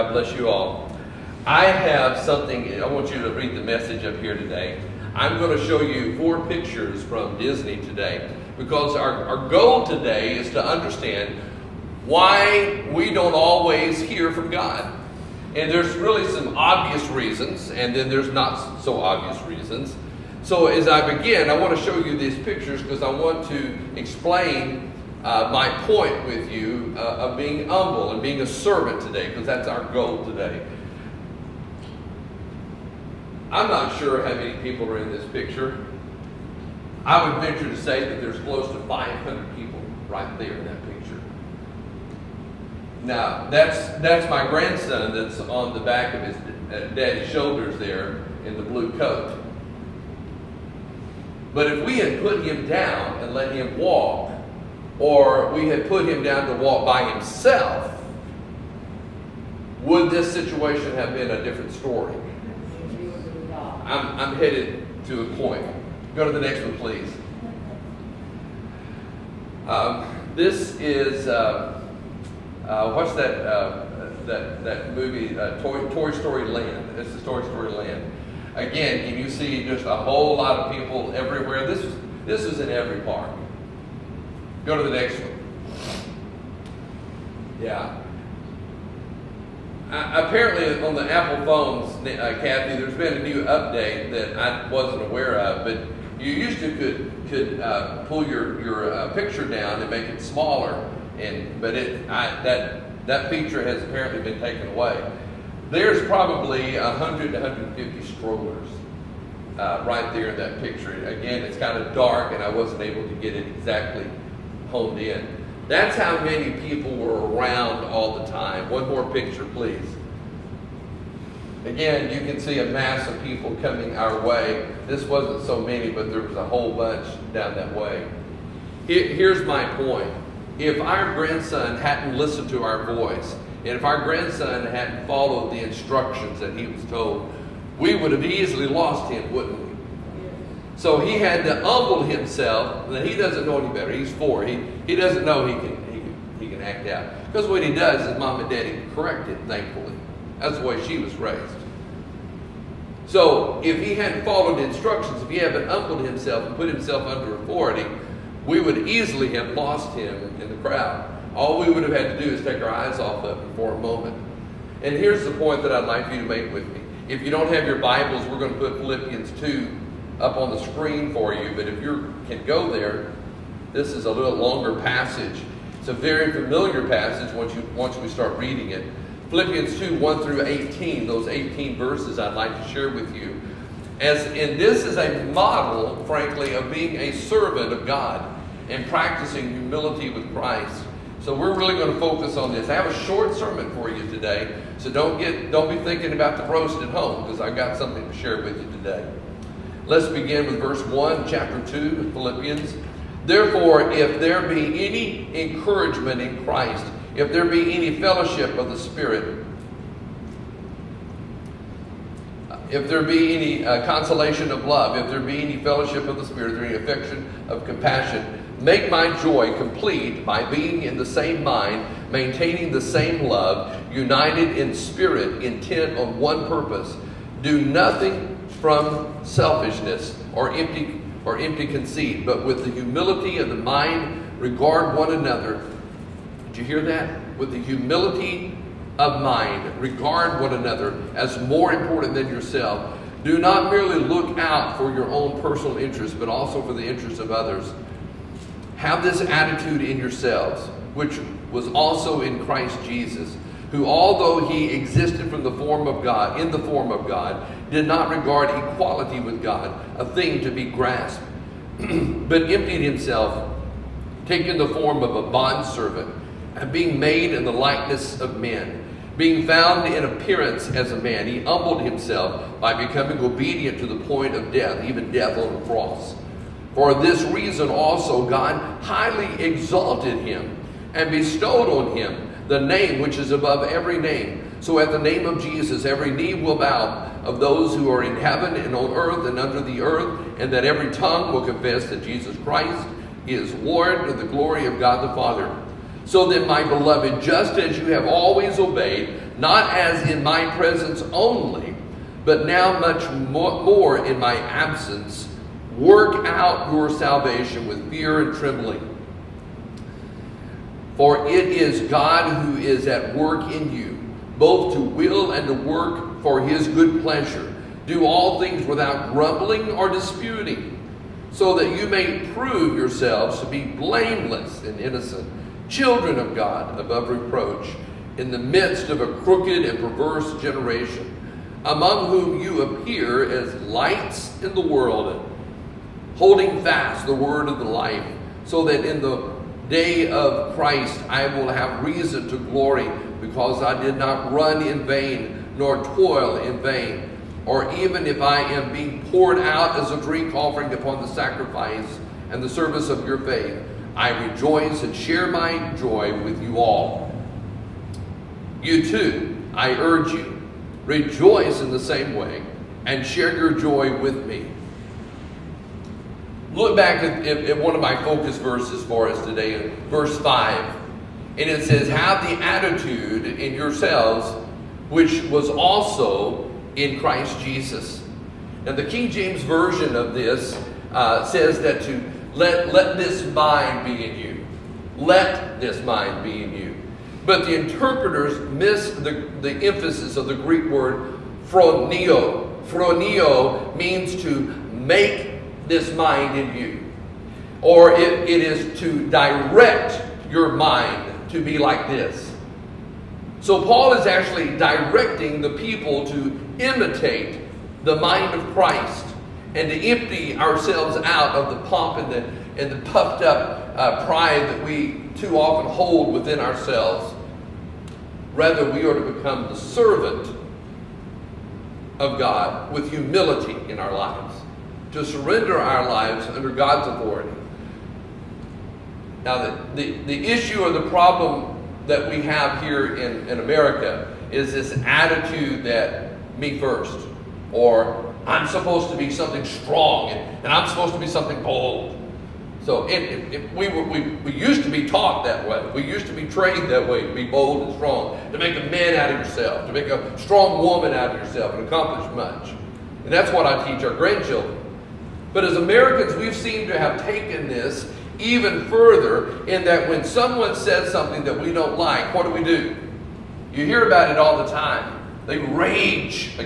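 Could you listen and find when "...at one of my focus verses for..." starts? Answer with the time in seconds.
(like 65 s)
367 s.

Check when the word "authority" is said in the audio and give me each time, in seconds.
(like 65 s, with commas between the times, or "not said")
157 s, 426 s.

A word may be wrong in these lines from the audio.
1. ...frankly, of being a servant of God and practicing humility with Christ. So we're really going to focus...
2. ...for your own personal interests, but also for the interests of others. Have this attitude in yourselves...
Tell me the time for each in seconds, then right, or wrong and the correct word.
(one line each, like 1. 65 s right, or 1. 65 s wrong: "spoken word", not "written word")
1. 186 s right
2. 244 s right.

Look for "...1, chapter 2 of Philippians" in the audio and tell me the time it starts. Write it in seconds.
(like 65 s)
200 s.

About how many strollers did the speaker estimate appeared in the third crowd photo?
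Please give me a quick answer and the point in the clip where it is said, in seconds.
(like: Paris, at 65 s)
100 to 150, at 106 s.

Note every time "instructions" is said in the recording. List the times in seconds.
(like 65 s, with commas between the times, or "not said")
135 s, 154 s.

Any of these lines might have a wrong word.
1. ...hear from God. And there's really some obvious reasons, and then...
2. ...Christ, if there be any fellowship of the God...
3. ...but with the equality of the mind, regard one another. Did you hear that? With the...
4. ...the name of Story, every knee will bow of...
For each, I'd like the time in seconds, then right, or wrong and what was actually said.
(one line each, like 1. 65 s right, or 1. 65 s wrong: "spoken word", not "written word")
1. 14 s right
2. 206 s wrong: "Spirit", not "God"
3. 232 s wrong: "humility", not "equality"
4. 284 s wrong: "Jesus", not "Story".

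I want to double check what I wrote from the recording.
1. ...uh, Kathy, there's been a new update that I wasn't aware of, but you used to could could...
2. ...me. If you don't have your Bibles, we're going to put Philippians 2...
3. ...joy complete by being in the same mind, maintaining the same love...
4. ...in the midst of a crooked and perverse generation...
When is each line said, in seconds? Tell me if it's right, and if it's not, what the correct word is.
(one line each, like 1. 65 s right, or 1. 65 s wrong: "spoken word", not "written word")
1. 92 s right
2. 166 s right
3. 219 s right
4. 328 s right.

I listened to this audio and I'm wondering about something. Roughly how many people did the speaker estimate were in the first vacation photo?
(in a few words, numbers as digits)
500.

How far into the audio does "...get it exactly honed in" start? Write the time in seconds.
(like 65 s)
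113 s.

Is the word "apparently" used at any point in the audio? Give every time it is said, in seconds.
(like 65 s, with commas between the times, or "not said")
89 s, 103 s.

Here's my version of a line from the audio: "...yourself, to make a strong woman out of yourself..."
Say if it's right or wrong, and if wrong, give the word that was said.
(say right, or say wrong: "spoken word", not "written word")
right.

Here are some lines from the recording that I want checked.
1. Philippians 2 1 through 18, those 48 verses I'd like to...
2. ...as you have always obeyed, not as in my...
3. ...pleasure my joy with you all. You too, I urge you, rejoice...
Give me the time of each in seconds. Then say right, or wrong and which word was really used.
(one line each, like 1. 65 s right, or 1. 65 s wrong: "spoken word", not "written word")
1. 179 s wrong: "18", not "48"
2. 297 s right
3. 354 s wrong: "share", not "pleasure".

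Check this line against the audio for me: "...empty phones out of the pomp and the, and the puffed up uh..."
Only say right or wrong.
wrong.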